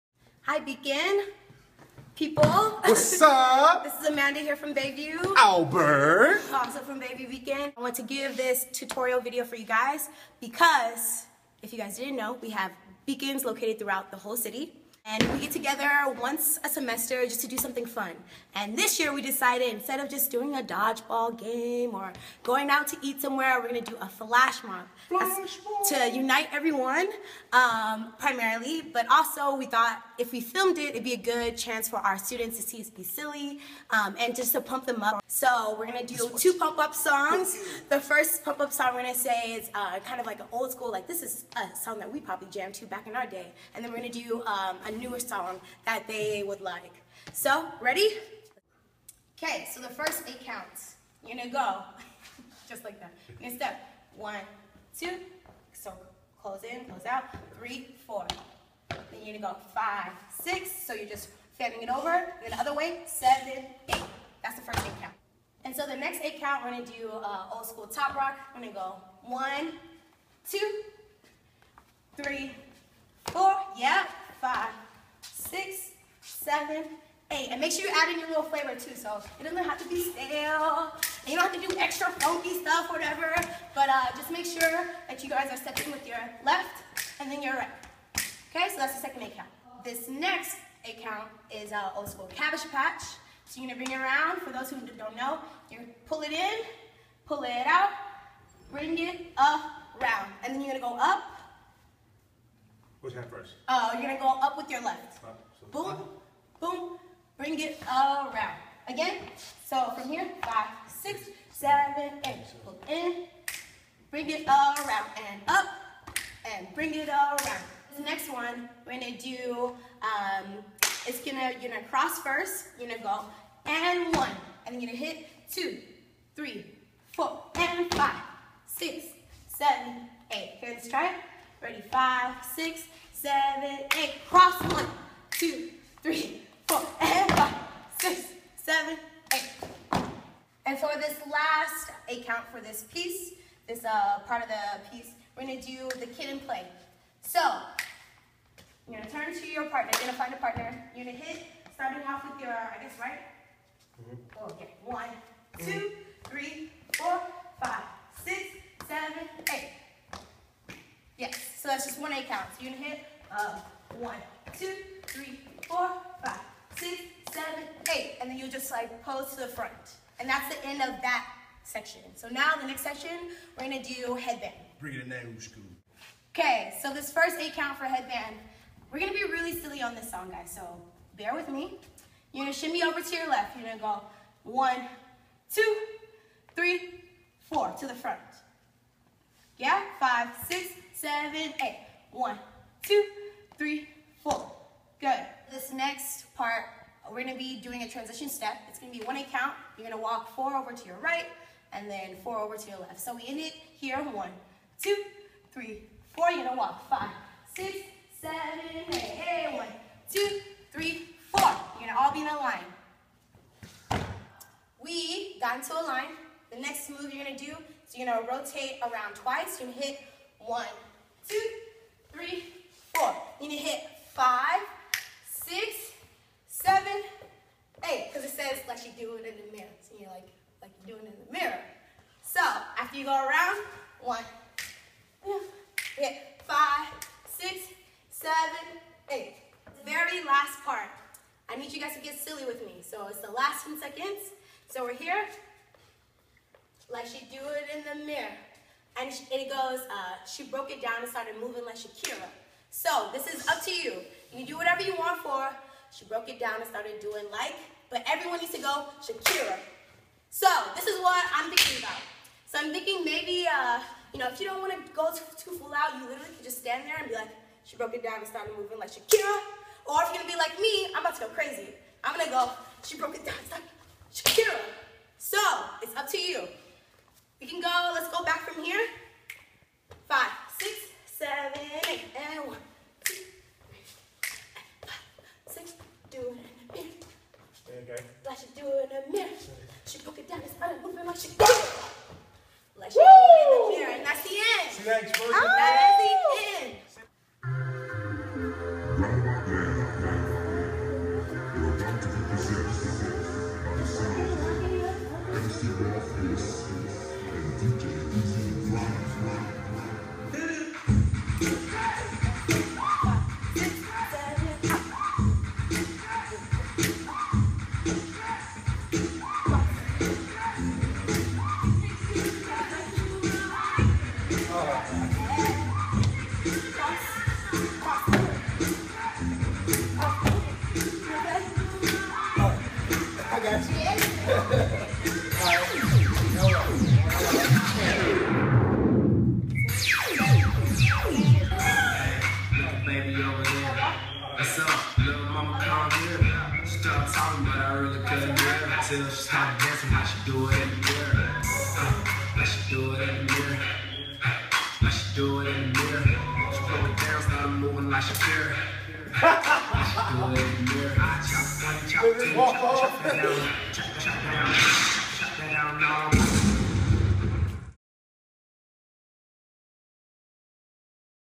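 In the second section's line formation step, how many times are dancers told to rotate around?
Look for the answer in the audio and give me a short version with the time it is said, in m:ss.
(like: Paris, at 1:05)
2, at 3:39.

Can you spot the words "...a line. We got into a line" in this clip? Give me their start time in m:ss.
3:32.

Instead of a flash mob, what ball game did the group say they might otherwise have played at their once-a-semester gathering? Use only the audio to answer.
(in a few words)
dodgeball.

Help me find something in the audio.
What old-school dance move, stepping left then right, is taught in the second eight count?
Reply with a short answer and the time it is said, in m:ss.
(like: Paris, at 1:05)
top rock, at 1:07.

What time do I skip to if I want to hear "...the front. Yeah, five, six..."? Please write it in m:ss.
3:07.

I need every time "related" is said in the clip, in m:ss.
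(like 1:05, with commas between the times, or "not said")
not said.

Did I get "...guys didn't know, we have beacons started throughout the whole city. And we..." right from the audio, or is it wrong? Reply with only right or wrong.
wrong.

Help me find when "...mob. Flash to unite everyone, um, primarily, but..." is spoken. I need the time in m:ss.
0:24.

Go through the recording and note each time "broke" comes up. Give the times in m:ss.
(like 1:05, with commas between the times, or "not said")
4:10, 4:16, 4:27, 4:32, 4:49.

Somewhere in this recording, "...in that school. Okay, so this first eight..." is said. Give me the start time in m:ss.
2:55.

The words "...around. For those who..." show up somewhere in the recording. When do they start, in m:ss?
1:34.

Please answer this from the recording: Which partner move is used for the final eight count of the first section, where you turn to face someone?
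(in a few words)
Kid 'n Play.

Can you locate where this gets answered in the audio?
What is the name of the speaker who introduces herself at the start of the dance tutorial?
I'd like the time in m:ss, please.
0:04.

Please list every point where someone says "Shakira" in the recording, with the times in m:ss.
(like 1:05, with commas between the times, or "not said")
4:11, 4:19, 4:28, 4:34, 4:51.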